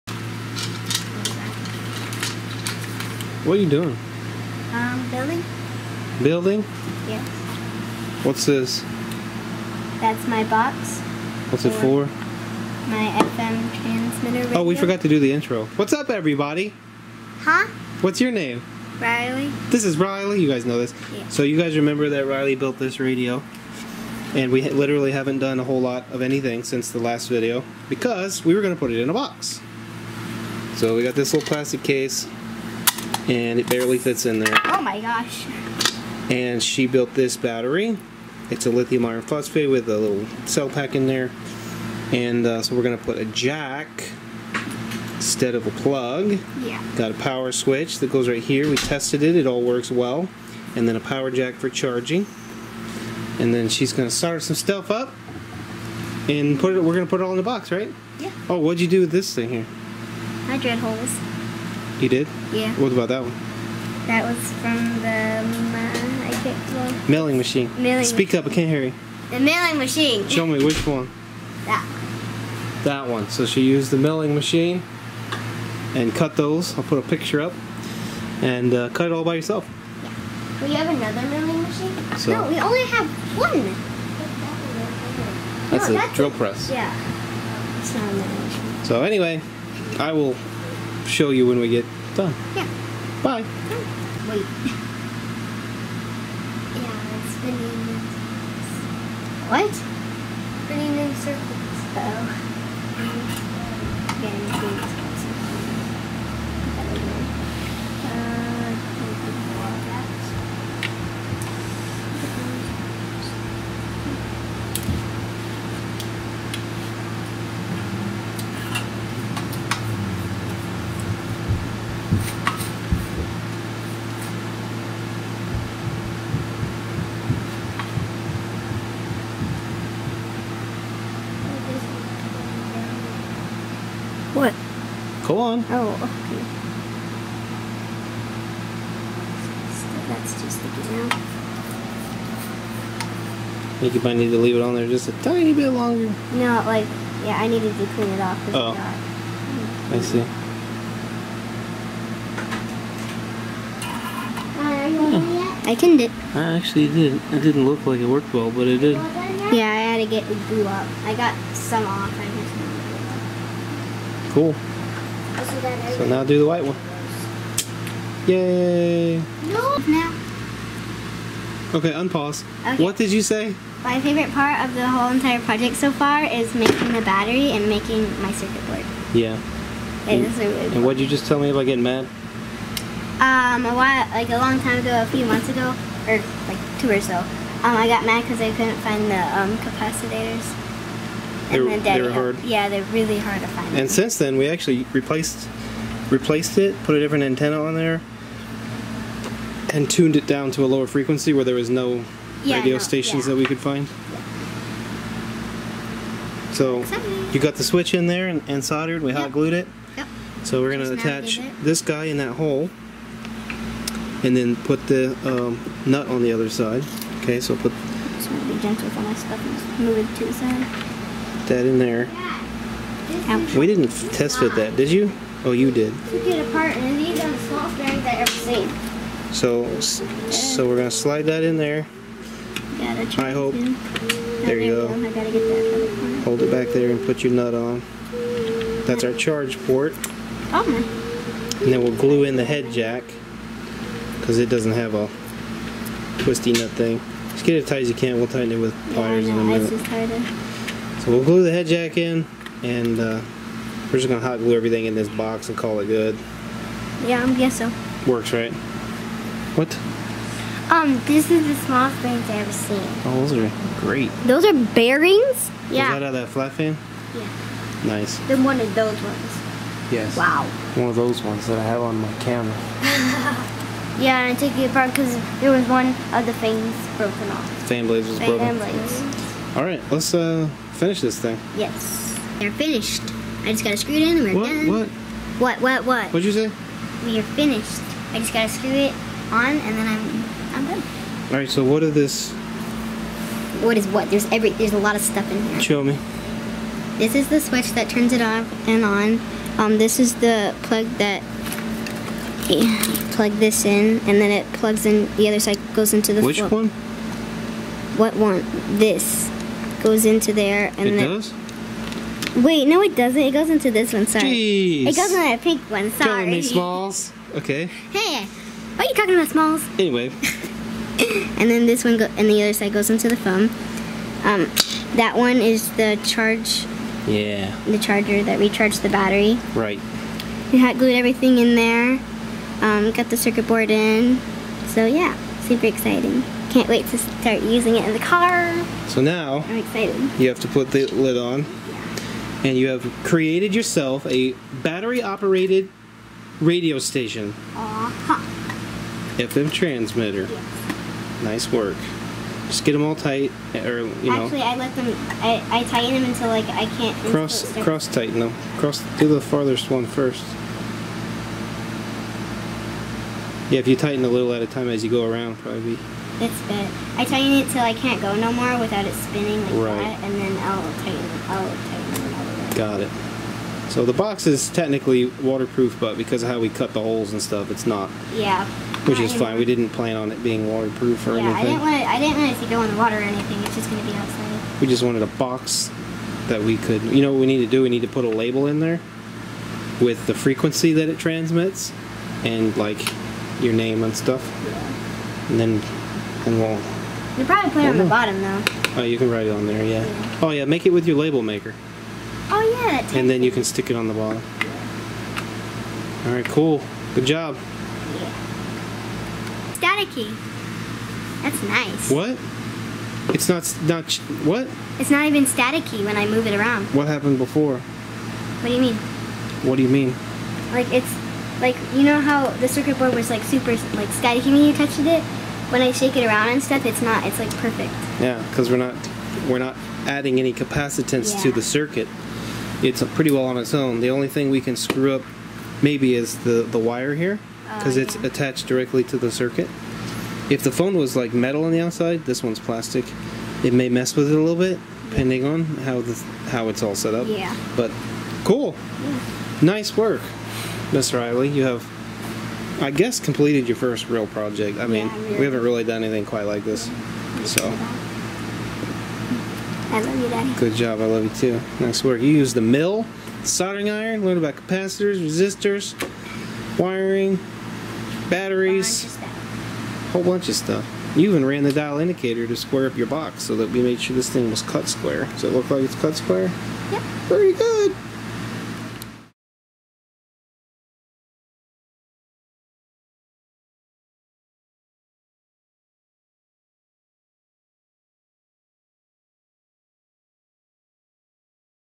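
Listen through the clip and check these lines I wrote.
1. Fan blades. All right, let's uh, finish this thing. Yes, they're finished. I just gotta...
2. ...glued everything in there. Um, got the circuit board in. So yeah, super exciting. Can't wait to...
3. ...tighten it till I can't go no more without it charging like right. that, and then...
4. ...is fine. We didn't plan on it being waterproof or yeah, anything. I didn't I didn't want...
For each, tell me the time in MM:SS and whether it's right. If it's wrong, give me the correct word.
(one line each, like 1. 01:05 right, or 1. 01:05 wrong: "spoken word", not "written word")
1. 04:38 right
2. 05:30 right
3. 06:07 wrong: "spinning", not "charging"
4. 06:19 right.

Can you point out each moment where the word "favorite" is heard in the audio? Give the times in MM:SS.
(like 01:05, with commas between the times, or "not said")
02:53.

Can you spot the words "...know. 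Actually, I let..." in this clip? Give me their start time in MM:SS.
05:54.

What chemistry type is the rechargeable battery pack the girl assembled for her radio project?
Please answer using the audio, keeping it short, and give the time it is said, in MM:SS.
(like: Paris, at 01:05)
lithium iron phosphate, at 00:38.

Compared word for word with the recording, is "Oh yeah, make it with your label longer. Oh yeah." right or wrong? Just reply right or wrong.
wrong.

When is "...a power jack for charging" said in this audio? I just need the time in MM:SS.
00:50.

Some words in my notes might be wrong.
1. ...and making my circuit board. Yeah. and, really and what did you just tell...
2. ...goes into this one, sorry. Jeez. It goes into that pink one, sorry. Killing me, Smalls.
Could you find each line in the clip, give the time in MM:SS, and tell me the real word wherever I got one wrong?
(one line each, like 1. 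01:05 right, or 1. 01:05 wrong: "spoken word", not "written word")
1. 02:57 right
2. 05:13 right.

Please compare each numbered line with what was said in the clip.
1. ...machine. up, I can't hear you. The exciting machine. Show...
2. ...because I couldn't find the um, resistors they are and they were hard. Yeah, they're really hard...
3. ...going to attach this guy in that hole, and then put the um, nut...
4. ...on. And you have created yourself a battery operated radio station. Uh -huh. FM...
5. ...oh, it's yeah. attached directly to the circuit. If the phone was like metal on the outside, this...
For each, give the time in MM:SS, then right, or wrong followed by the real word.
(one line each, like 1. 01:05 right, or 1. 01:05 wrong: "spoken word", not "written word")
1. 01:08 wrong: "milling", not "exciting"
2. 03:08 wrong: "capacitors", not "resistors"
3. 03:30 right
4. 05:41 right
5. 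07:17 right.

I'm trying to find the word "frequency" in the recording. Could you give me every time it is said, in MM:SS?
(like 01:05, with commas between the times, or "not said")
03:20, 06:30.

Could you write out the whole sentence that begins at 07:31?
You have I guess, completed your first real project.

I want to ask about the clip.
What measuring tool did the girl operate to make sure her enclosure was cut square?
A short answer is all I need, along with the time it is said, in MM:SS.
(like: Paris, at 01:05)
dial indicator, at 07:51.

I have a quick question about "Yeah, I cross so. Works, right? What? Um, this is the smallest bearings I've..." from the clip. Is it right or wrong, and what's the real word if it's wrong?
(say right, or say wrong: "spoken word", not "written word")
wrong: "guess", not "cross".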